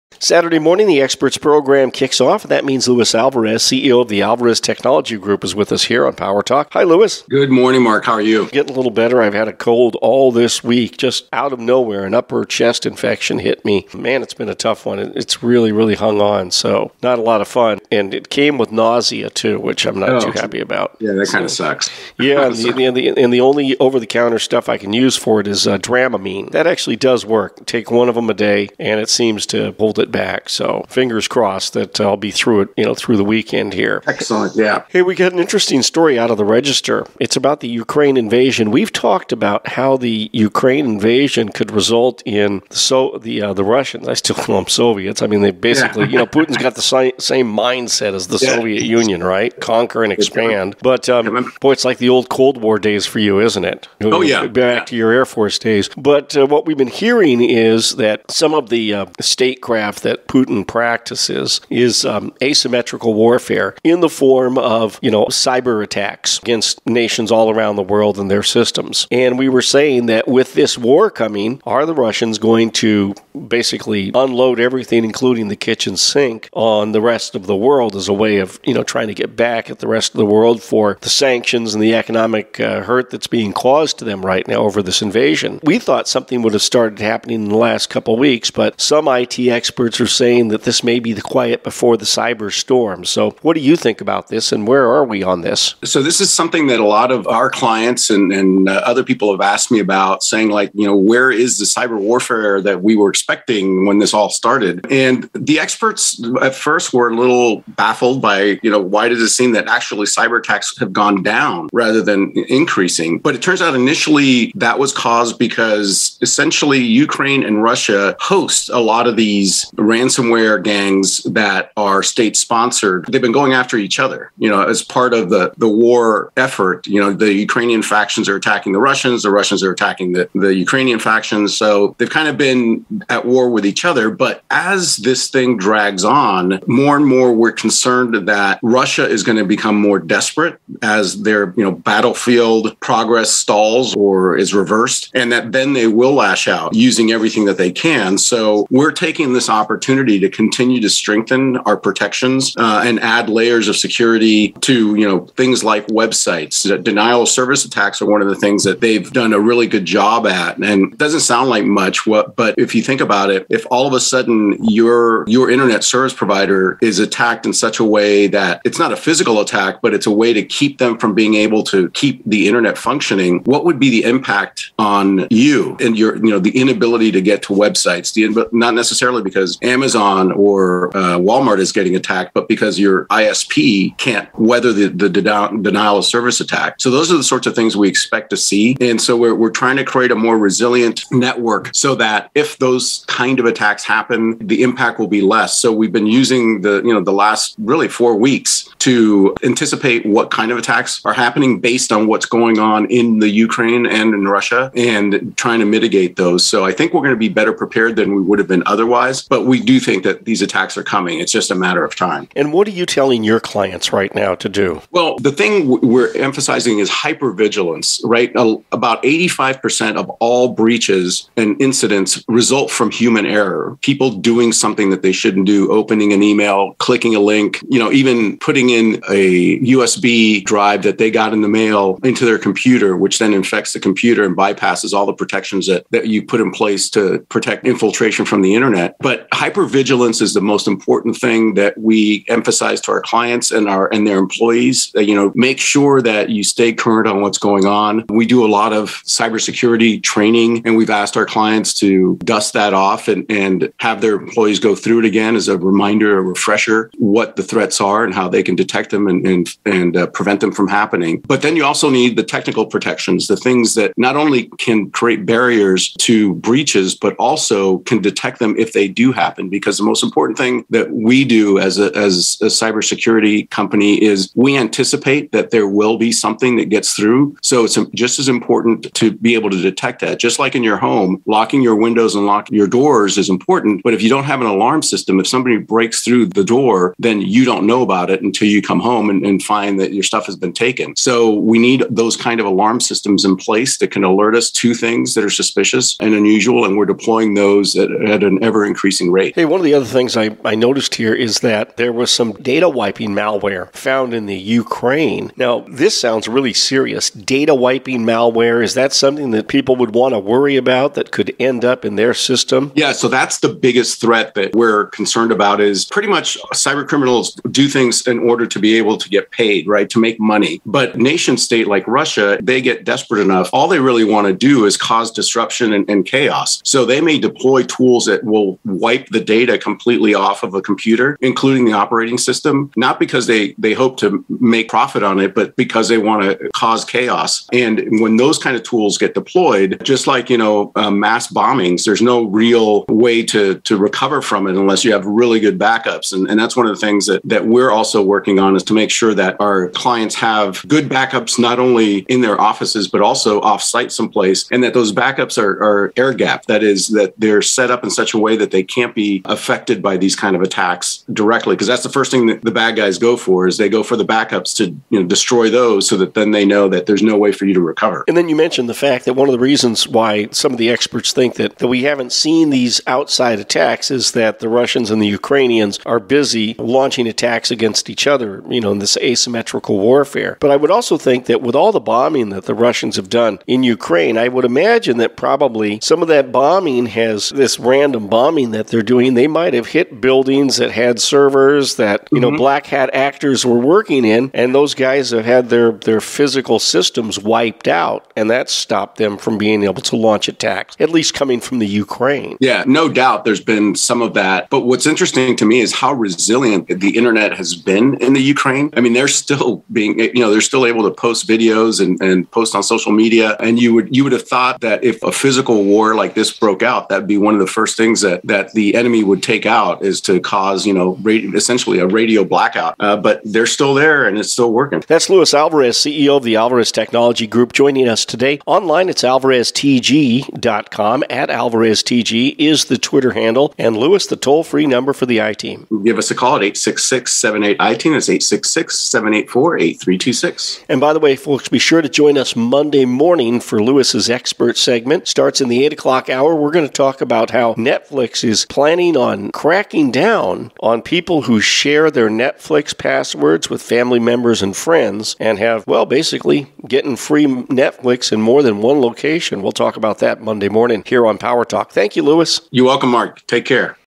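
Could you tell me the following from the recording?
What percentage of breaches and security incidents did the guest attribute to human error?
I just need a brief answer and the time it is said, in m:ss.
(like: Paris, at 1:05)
85%, at 3:38.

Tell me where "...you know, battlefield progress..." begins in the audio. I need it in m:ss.
2:21.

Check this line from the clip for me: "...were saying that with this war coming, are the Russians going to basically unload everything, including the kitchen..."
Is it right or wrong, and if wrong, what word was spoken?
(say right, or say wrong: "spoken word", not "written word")
right.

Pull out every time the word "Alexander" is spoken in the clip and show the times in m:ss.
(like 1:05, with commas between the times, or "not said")
not said.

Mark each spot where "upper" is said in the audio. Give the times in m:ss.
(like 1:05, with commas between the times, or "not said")
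0:12.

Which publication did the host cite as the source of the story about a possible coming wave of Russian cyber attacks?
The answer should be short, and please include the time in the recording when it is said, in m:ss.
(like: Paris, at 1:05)
The Register, at 0:36.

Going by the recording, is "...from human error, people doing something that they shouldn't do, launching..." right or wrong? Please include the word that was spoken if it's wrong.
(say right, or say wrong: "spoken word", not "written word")
wrong: "opening", not "launching".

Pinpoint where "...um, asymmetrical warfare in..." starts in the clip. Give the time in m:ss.
1:02.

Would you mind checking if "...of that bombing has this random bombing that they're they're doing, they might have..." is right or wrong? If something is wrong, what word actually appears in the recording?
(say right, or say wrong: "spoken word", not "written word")
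right.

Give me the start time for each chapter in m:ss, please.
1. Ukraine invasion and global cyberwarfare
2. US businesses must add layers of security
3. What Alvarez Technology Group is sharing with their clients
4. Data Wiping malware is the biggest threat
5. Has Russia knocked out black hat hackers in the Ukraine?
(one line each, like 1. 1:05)
1. 0:37
2. 2:27
3. 3:32
4. 5:03
5. 6:37.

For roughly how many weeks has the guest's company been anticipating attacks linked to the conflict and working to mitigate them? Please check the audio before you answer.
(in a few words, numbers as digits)
4 weeks.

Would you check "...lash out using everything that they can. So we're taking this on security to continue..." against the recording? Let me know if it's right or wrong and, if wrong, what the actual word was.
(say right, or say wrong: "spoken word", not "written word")
wrong: "opportunity", not "security".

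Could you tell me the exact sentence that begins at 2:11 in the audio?
So they've kind of been at war with each other.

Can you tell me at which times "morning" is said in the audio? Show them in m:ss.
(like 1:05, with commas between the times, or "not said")
0:00, 0:07, 7:22, 7:40.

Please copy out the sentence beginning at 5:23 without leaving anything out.
All they really want to do is cause disruption and, and chaos.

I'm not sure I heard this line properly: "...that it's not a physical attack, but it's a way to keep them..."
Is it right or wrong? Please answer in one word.
right.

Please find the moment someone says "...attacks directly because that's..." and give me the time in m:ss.
6:00.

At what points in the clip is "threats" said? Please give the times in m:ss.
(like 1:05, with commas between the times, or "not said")
4:17, 5:14.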